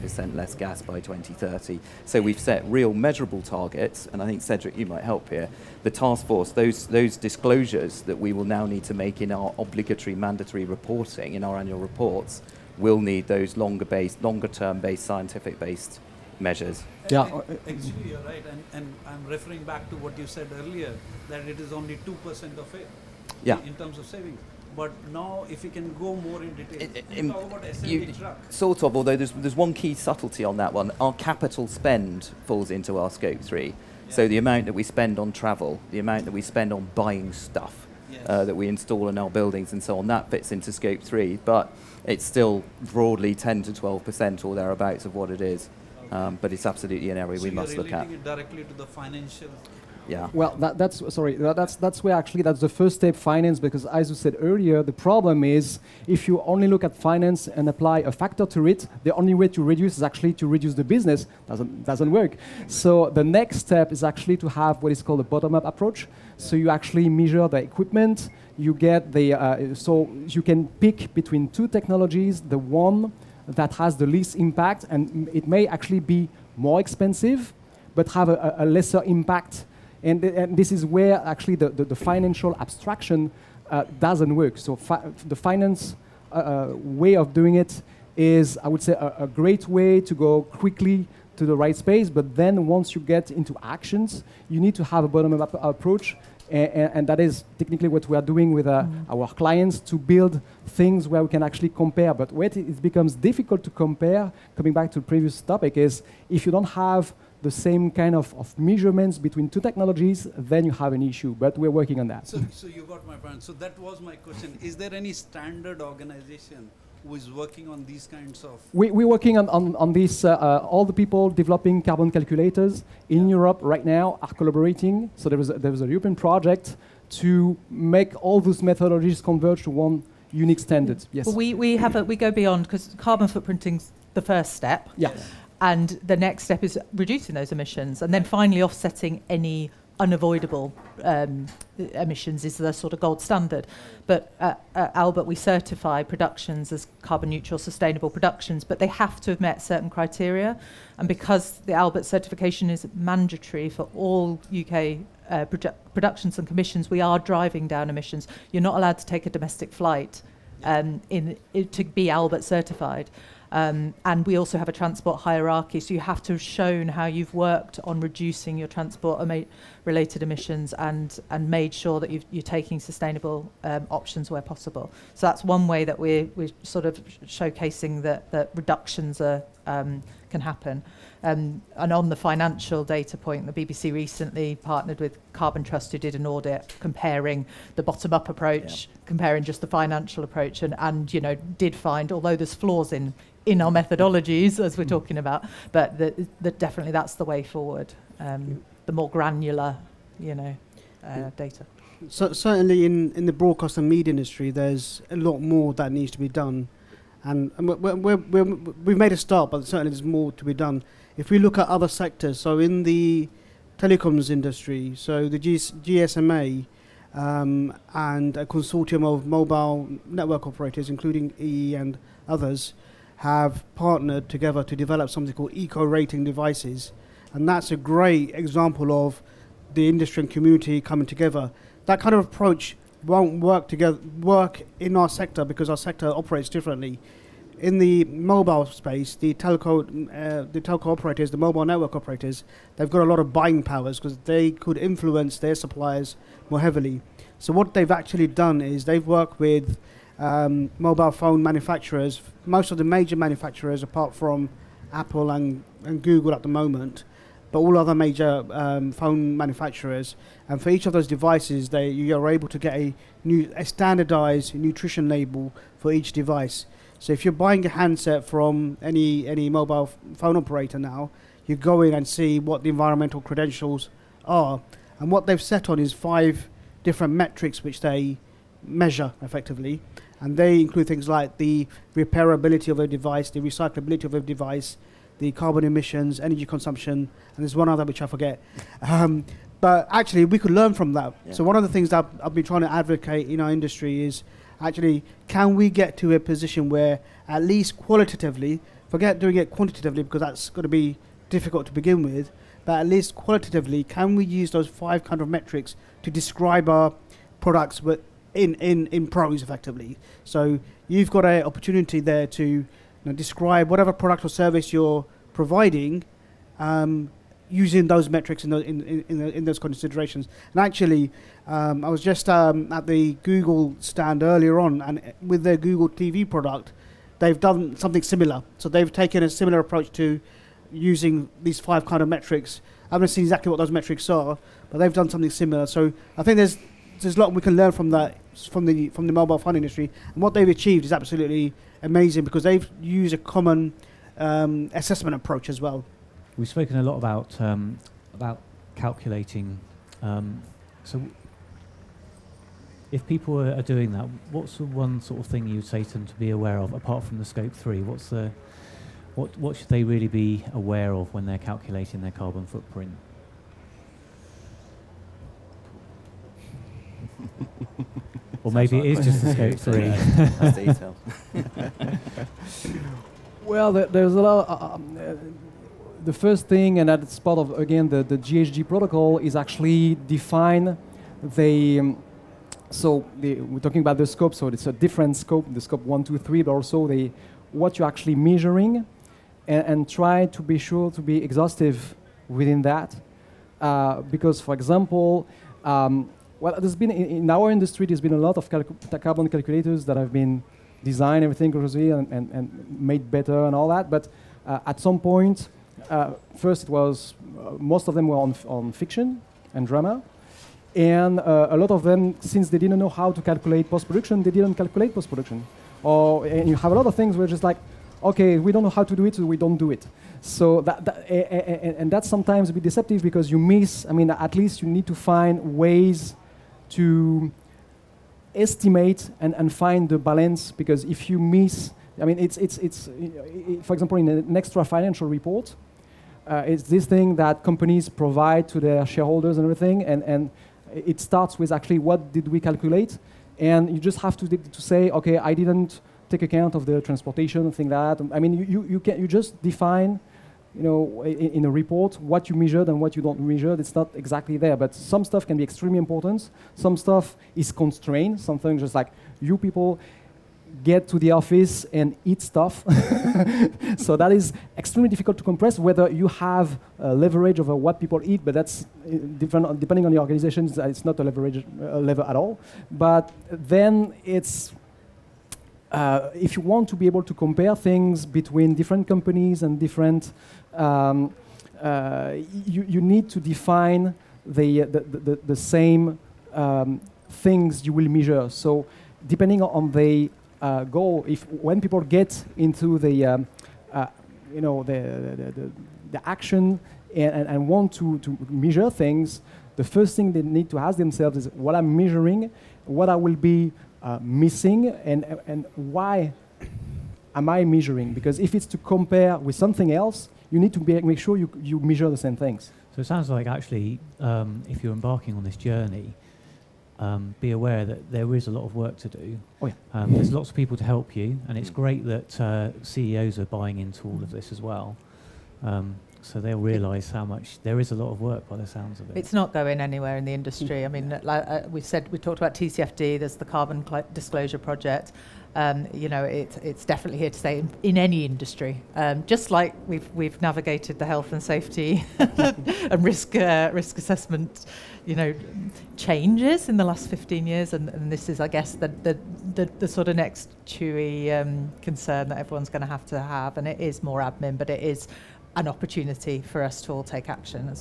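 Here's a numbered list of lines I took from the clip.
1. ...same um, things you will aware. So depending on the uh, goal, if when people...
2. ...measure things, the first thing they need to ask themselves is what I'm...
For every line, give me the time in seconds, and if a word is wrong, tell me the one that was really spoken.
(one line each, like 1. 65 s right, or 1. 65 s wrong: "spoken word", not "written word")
1. 485 s wrong: "measure", not "aware"
2. 498 s right.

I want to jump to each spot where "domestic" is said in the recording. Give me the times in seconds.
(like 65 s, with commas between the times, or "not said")
159 s.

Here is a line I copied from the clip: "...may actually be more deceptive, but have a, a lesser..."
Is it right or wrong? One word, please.
wrong.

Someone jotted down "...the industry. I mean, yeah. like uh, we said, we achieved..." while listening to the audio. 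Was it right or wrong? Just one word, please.
wrong.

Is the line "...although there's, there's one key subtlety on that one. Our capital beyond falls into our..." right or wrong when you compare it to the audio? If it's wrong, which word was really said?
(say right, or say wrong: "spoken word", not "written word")
wrong: "spend", not "beyond".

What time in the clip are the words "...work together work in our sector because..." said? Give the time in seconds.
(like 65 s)
233 s.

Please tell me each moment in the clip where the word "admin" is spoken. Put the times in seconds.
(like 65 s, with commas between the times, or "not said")
553 s.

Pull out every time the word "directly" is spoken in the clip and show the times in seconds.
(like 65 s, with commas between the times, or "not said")
48 s.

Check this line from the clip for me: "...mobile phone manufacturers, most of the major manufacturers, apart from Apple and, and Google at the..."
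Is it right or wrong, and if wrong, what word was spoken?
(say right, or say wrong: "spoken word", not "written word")
right.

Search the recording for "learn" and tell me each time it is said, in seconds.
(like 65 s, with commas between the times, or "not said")
290 s, 337 s.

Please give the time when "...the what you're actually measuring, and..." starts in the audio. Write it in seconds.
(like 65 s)
386 s.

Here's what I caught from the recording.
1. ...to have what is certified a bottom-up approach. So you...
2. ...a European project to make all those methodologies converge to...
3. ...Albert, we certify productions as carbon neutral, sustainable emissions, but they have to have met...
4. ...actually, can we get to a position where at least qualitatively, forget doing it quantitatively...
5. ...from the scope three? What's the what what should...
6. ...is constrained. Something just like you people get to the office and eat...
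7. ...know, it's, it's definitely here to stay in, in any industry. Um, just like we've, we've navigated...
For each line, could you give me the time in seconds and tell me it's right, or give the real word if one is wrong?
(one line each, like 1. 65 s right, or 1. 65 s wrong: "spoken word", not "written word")
1. 64 s wrong: "called", not "certified"
2. 125 s right
3. 144 s wrong: "productions", not "emissions"
4. 294 s right
5. 357 s right
6. 457 s right
7. 535 s right.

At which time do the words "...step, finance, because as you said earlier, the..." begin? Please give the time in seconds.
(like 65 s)
52 s.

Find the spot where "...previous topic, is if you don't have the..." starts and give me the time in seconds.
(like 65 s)
105 s.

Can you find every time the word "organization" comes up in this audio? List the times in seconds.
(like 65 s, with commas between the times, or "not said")
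115 s, 469 s.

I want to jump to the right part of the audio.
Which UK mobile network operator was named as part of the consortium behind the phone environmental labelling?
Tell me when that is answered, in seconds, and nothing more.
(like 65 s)
221 s.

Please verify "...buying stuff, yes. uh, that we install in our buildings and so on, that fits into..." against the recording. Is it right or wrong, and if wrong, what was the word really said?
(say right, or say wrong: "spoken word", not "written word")
right.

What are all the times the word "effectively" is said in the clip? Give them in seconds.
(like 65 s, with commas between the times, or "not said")
279 s, 309 s.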